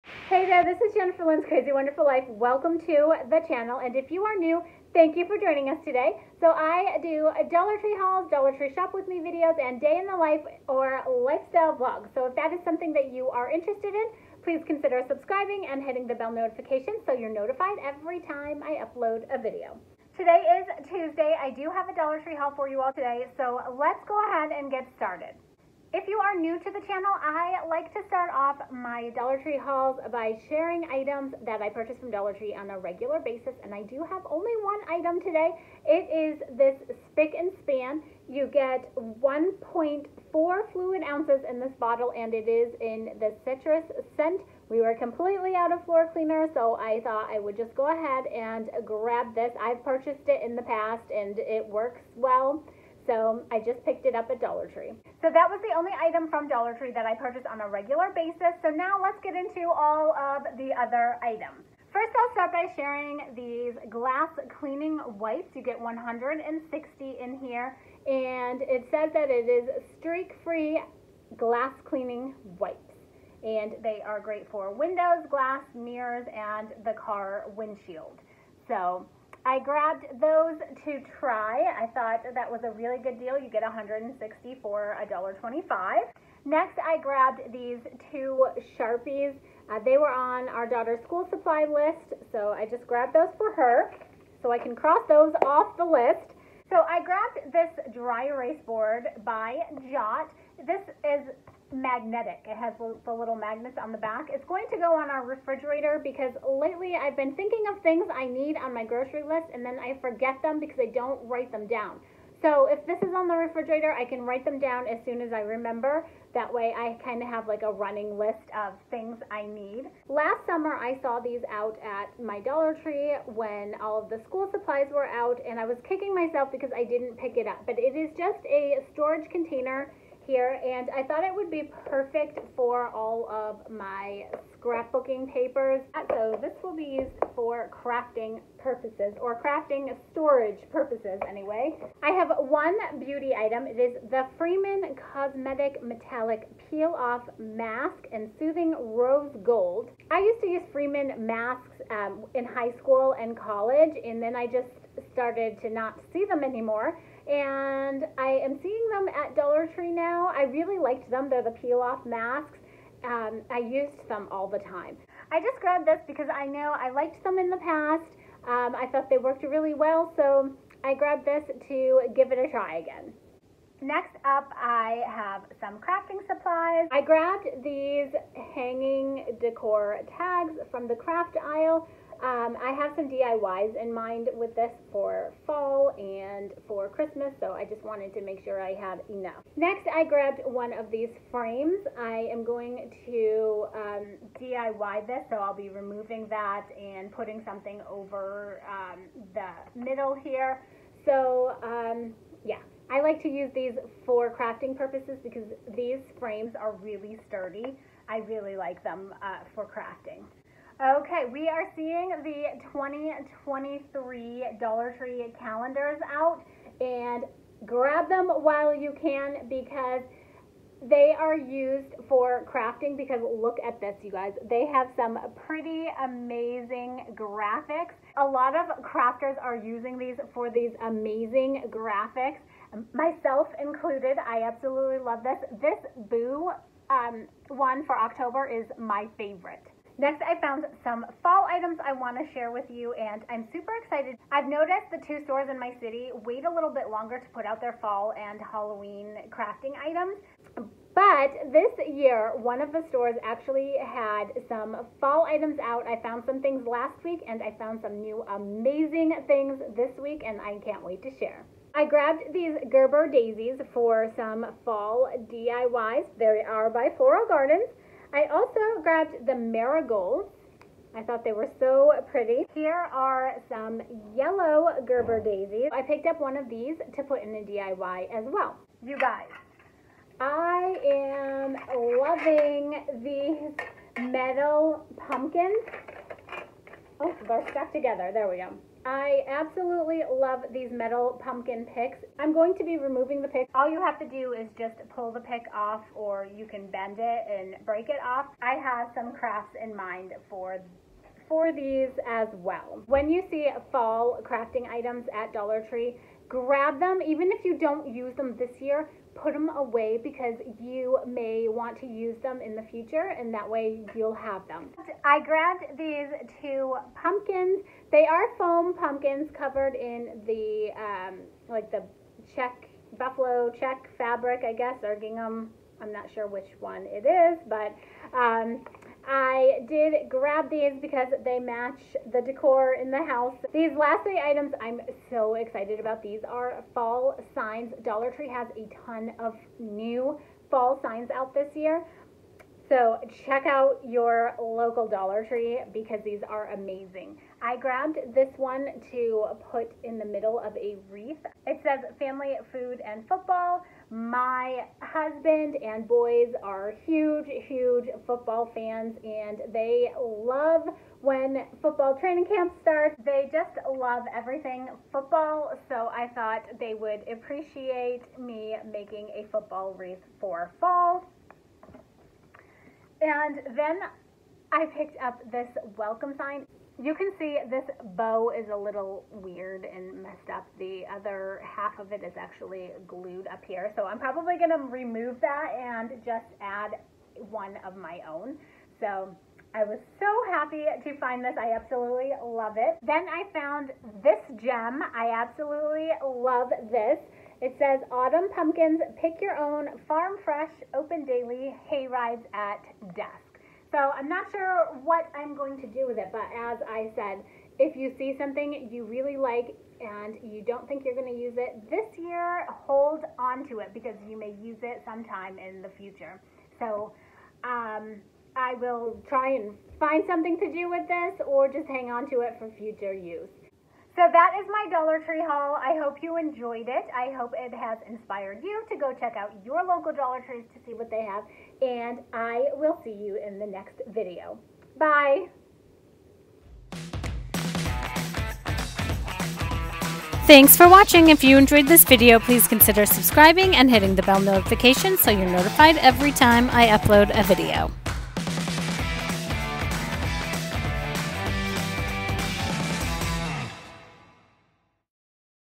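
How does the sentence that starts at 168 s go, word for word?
Um, I thought they worked really well, so I grabbed this to give it a try again.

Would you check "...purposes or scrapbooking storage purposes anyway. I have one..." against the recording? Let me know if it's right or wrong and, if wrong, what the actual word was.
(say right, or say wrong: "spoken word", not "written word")
wrong: "crafting", not "scrapbooking".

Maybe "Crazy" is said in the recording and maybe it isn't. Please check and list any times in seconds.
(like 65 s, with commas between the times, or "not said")
1 s.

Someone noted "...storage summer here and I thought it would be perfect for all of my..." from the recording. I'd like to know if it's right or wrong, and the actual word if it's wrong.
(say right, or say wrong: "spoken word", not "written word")
wrong: "container", not "summer".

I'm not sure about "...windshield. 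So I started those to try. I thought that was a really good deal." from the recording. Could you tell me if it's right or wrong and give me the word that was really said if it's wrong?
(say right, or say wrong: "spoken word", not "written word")
wrong: "grabbed", not "started".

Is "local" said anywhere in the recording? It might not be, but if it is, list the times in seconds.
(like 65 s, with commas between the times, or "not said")
344 s, 429 s.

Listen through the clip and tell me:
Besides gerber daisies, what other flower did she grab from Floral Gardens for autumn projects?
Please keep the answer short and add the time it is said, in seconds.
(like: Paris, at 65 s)
marigolds, at 269 s.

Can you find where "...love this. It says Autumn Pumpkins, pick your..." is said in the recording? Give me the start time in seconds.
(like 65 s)
396 s.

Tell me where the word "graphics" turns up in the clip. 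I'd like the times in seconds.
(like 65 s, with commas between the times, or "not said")
227 s, 231 s.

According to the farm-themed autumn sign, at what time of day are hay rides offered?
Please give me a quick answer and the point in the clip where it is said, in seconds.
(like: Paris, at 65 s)
dusk, at 402 s.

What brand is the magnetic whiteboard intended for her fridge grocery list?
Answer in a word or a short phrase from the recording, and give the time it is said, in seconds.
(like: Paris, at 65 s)
Jot, at 99 s.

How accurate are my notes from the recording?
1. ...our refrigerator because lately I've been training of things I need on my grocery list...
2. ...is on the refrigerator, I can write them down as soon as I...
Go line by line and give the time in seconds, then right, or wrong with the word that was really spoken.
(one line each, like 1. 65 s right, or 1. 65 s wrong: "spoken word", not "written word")
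1. 105 s wrong: "thinking", not "training"
2. 113 s right.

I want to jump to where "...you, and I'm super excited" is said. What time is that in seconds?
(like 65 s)
242 s.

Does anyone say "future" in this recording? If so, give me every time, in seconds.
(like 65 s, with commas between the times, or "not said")
312 s, 415 s, 422 s.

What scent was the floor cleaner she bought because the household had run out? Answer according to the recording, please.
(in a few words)
citrus.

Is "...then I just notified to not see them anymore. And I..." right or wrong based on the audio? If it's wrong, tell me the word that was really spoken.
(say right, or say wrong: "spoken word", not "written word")
wrong: "started", not "notified".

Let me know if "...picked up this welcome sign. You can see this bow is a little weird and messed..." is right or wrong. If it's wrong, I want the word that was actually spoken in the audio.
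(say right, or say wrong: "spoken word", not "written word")
right.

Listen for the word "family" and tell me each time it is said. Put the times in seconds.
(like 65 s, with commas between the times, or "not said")
351 s.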